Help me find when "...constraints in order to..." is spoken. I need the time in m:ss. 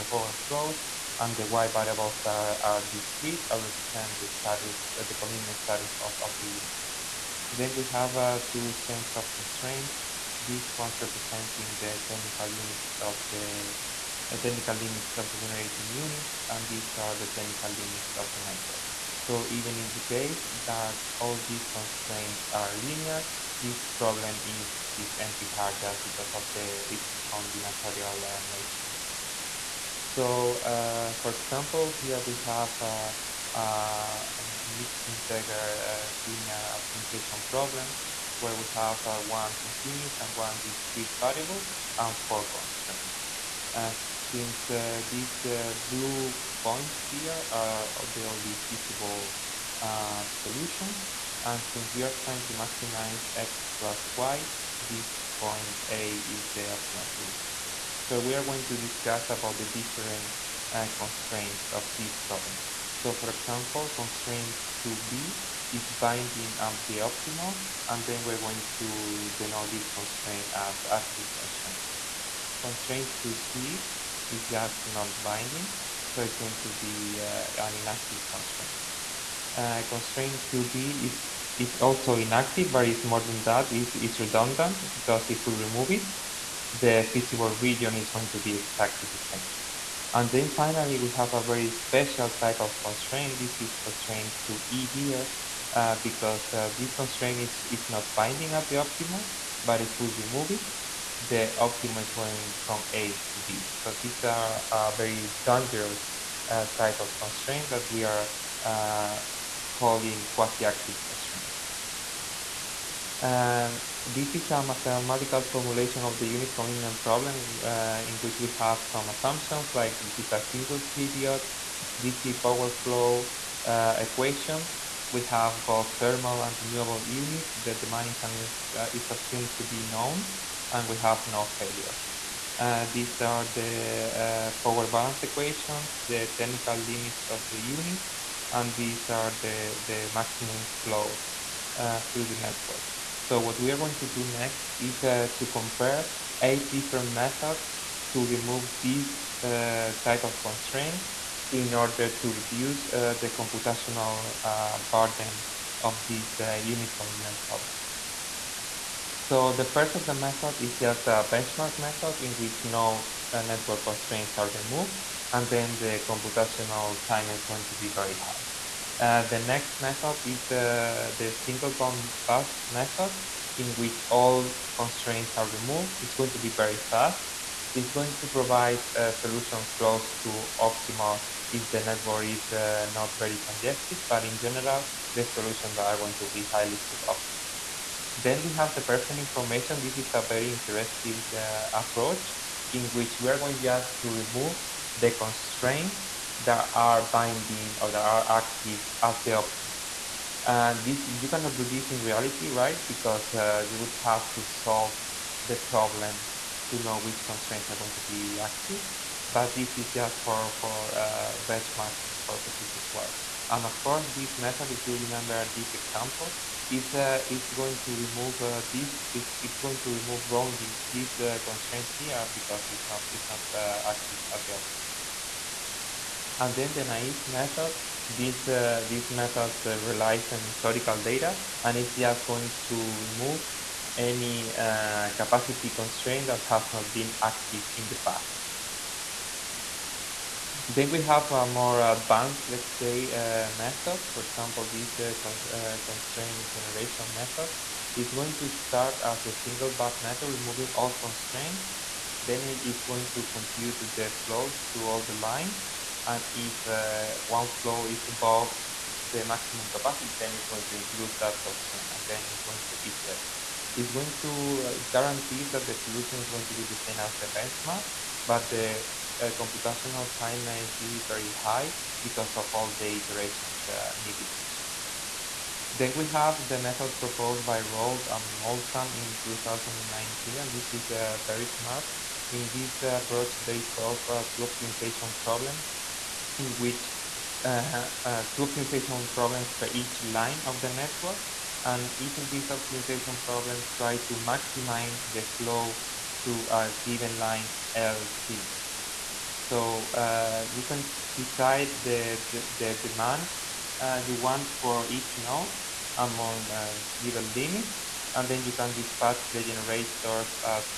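2:30.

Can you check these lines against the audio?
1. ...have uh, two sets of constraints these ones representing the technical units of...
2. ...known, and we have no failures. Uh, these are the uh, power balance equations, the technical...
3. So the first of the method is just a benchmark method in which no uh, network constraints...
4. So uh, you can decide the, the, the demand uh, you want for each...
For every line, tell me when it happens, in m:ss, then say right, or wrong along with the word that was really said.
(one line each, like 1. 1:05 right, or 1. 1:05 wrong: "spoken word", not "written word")
1. 0:07 right
2. 2:09 right
3. 2:39 right
4. 4:59 right.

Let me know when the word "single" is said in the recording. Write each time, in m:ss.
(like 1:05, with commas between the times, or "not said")
2:00, 2:51, 4:09.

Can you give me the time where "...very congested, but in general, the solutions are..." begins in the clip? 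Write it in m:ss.
3:03.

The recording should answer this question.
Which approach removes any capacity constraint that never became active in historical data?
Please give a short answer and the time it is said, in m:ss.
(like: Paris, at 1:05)
naive method, at 3:46.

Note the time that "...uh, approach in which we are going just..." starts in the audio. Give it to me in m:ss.
3:11.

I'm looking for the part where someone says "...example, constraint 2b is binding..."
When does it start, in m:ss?
1:03.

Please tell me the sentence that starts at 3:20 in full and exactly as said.
And this you cannot do this in reality, right?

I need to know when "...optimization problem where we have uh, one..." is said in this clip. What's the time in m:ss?
0:36.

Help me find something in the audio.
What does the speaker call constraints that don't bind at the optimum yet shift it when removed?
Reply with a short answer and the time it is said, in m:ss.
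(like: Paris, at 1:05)
quasi-active constraints, at 1:50.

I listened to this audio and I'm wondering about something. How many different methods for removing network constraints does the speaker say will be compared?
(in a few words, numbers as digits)
8.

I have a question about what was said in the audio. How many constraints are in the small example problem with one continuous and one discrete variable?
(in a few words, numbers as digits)
4.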